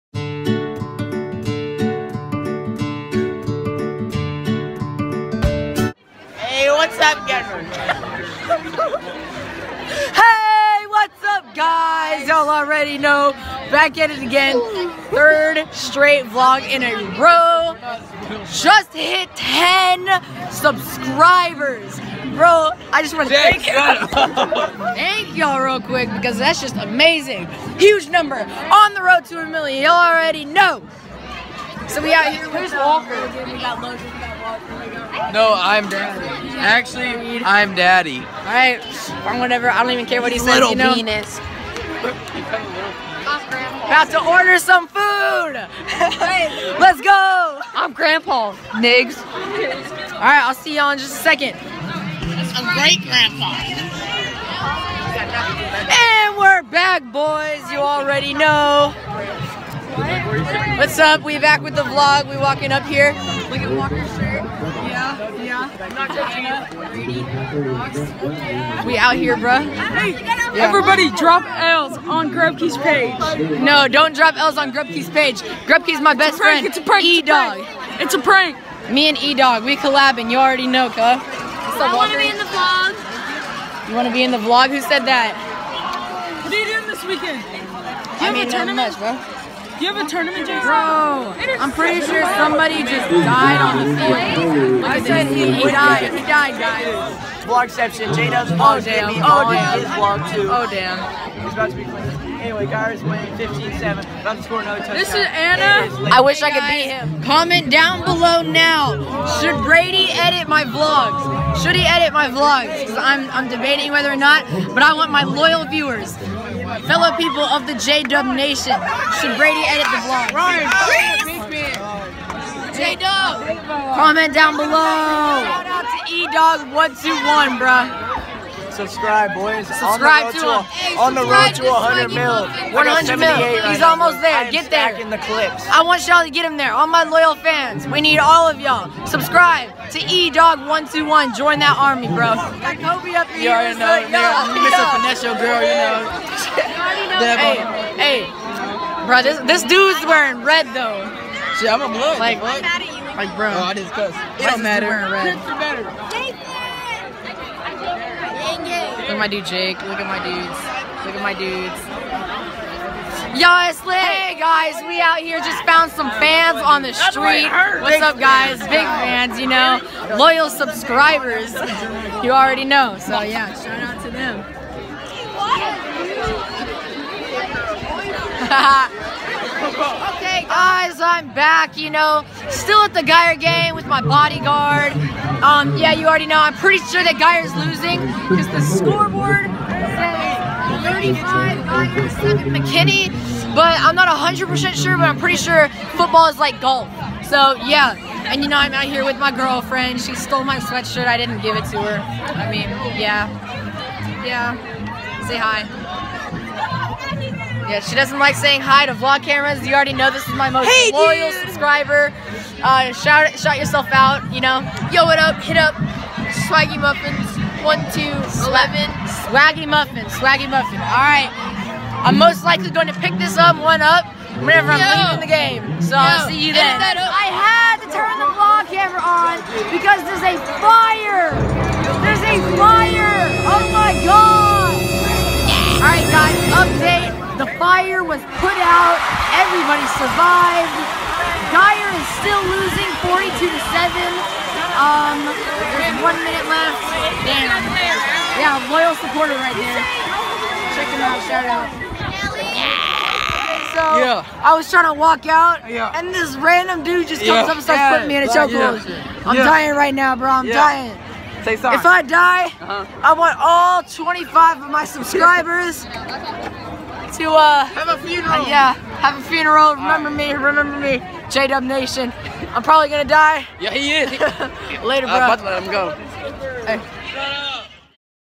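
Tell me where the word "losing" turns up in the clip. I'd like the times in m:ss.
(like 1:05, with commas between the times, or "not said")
3:07, 4:02.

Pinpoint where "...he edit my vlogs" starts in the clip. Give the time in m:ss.
1:51.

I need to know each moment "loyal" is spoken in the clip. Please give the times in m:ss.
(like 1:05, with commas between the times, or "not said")
1:55, 2:17, 2:50, 3:30, 4:08.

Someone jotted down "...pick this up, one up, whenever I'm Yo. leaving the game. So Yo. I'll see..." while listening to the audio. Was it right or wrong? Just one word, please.
right.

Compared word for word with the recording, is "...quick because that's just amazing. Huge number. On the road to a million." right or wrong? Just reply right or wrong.
right.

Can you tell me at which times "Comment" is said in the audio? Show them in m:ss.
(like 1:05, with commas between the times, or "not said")
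1:47, 2:03.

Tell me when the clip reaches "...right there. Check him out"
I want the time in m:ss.
4:09.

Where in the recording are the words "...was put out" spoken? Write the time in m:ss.
3:58.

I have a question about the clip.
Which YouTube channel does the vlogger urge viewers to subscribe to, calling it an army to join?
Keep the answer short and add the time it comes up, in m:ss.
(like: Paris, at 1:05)
E-Dog121, at 2:06.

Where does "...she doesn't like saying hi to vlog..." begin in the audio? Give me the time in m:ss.
3:27.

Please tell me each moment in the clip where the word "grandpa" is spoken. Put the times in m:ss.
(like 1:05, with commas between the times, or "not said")
0:47, 0:53.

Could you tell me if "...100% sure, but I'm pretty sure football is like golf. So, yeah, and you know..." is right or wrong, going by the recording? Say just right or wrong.
right.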